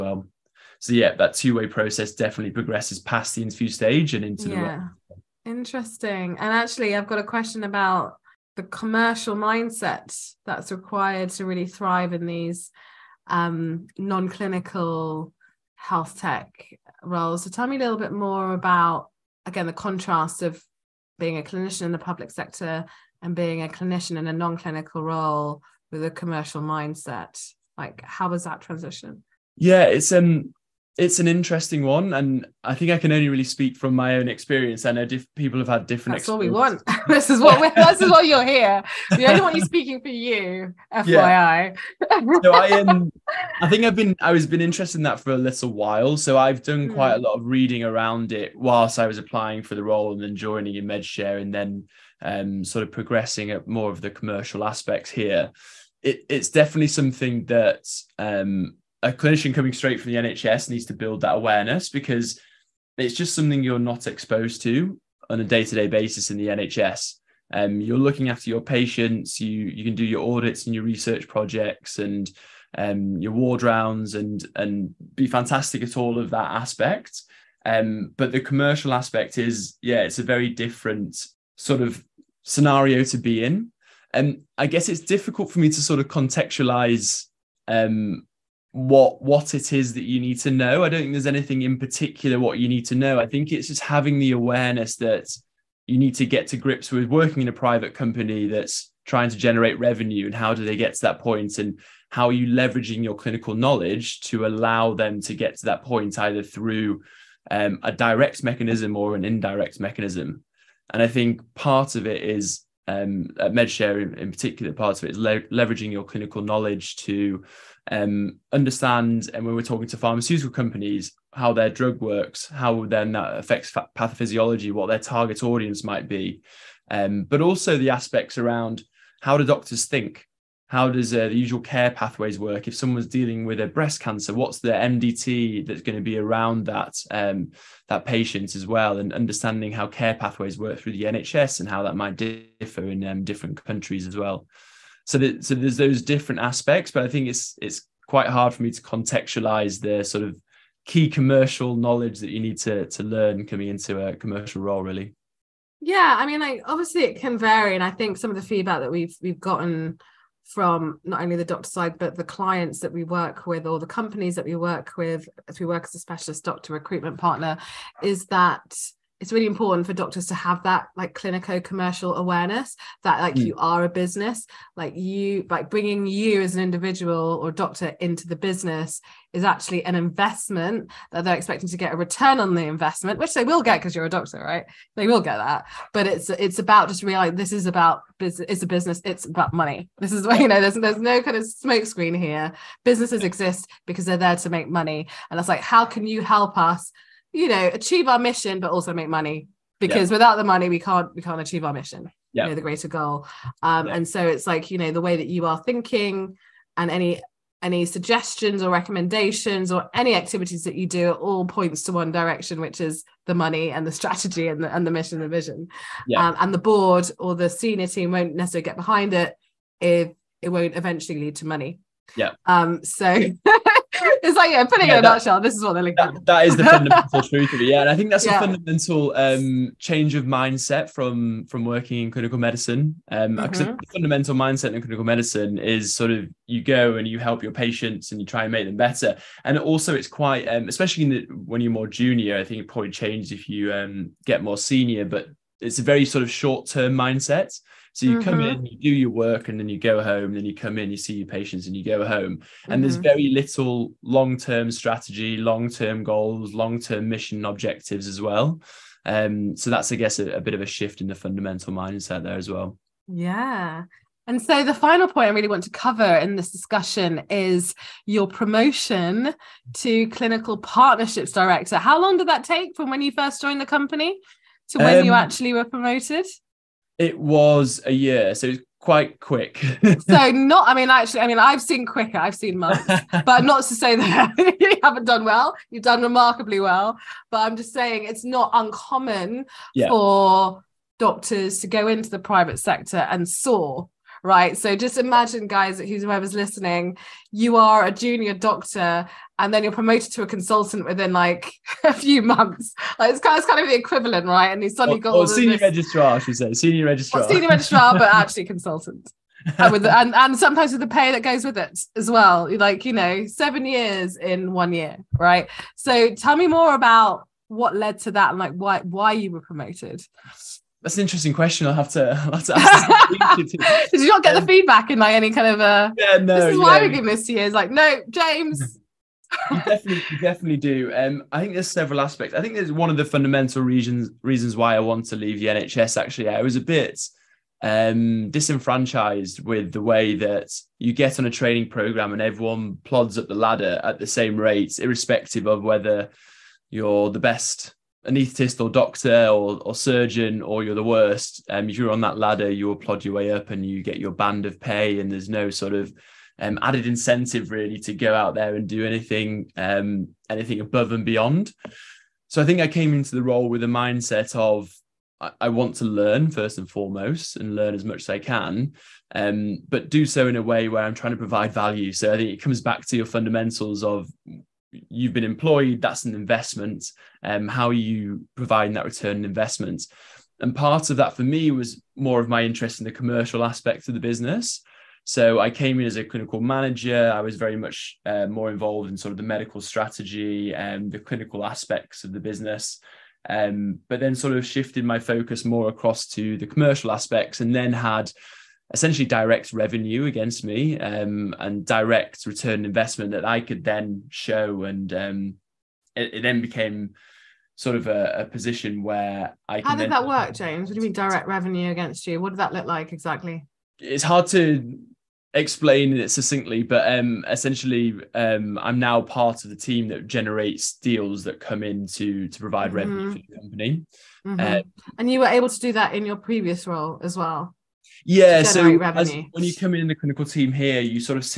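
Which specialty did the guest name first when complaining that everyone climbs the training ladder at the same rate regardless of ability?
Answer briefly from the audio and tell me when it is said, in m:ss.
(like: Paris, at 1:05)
Anaesthetist, at 5:48.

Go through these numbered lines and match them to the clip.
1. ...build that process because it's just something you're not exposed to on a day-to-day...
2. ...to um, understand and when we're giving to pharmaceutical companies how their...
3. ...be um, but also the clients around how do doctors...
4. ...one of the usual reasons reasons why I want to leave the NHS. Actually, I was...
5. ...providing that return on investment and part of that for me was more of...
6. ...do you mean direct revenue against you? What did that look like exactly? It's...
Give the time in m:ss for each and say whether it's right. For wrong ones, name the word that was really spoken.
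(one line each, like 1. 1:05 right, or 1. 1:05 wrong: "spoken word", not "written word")
1. 1:00 wrong: "awareness", not "process"
2. 1:56 wrong: "talking", not "giving"
3. 2:06 wrong: "aspects", not "clients"
4. 5:32 wrong: "fundamental", not "usual"
5. 6:18 right
6. 6:50 right.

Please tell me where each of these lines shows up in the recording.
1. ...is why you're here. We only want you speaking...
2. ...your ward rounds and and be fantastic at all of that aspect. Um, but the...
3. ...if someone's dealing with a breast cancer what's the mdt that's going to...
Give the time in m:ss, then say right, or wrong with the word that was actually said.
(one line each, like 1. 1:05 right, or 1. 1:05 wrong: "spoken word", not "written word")
1. 0:38 right
2. 1:13 right
3. 2:12 right.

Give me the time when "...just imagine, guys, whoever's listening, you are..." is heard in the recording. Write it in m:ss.
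4:54.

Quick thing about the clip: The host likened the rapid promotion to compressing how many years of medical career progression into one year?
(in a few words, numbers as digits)
7.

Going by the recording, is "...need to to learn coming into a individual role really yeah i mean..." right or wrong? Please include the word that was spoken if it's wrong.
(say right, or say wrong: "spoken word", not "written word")
wrong: "commercial", not "individual".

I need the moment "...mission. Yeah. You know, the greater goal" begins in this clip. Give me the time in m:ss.
3:21.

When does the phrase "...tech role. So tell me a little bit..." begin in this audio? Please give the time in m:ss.
0:16.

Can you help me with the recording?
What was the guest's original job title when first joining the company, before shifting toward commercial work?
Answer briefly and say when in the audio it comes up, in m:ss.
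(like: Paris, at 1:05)
Clinical manager, at 6:26.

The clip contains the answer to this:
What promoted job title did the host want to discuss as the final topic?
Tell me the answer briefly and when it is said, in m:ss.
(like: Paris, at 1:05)
Clinical partnerships director, at 4:30.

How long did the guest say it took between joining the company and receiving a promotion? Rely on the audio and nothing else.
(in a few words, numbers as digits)
A year.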